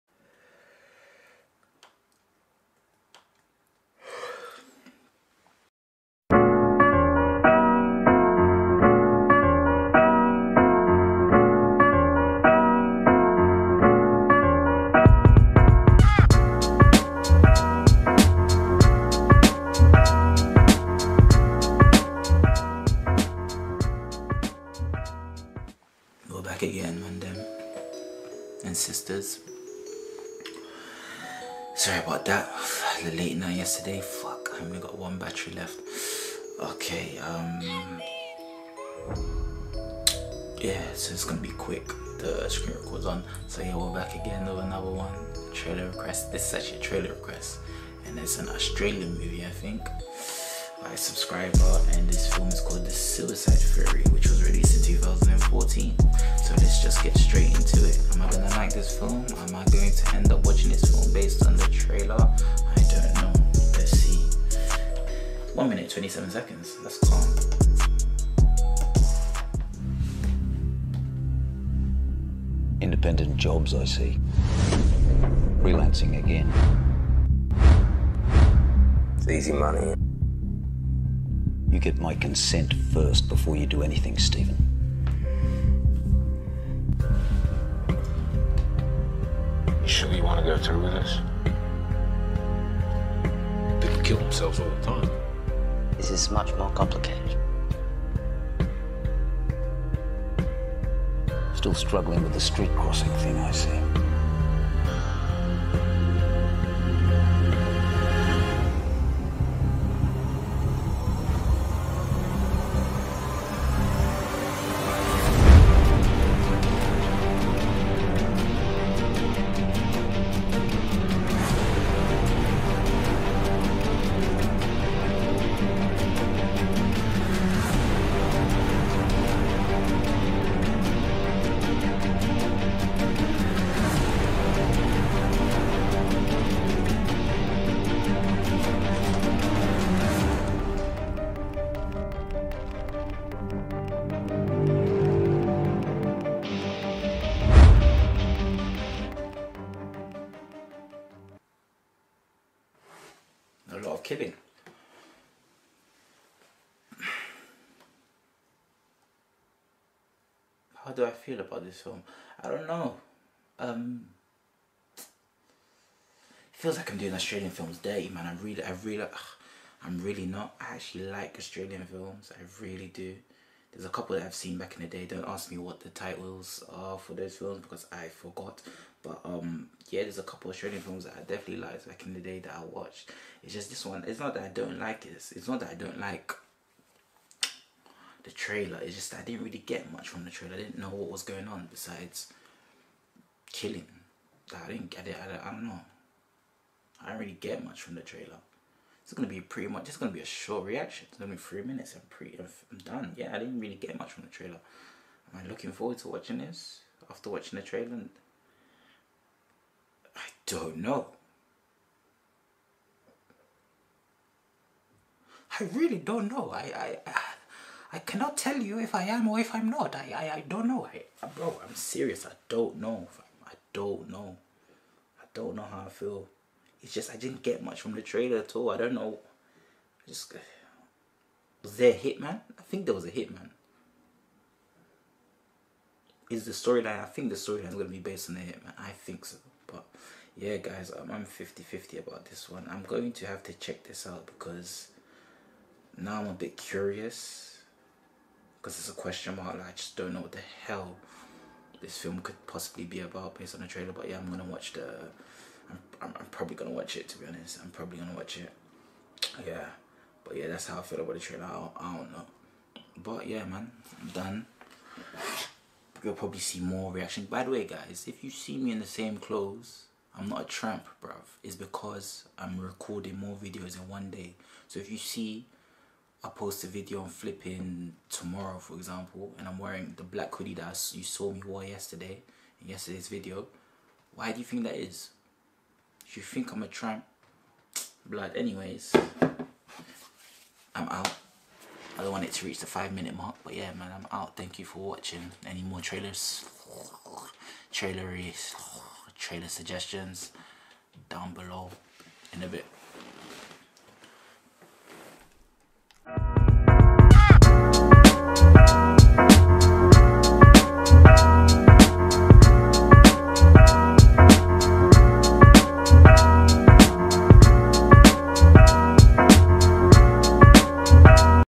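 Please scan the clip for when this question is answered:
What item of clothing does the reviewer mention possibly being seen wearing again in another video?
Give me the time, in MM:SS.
04:40.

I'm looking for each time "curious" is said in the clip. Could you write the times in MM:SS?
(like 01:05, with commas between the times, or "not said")
04:06.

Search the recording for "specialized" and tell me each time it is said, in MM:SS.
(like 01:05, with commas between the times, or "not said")
not said.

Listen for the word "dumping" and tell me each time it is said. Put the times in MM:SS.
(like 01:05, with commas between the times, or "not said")
not said.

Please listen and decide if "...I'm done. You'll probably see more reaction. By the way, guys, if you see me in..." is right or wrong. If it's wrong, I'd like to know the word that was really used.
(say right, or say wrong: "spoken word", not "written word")
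right.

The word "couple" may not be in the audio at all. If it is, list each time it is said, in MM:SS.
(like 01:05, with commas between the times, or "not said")
02:53, 03:00.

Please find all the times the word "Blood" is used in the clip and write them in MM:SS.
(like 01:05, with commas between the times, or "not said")
04:48.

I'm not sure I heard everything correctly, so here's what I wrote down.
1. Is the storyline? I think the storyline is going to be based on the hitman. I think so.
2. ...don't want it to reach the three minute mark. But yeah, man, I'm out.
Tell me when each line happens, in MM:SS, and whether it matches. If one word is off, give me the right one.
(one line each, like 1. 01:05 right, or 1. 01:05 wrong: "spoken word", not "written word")
1. 03:56 right
2. 04:52 wrong: "five", not "three".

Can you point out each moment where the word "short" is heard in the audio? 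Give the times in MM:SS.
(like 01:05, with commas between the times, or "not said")
03:20.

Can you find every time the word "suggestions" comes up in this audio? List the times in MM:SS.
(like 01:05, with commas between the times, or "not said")
04:59.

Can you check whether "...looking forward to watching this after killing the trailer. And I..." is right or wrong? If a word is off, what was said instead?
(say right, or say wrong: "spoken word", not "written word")
wrong: "watching", not "killing".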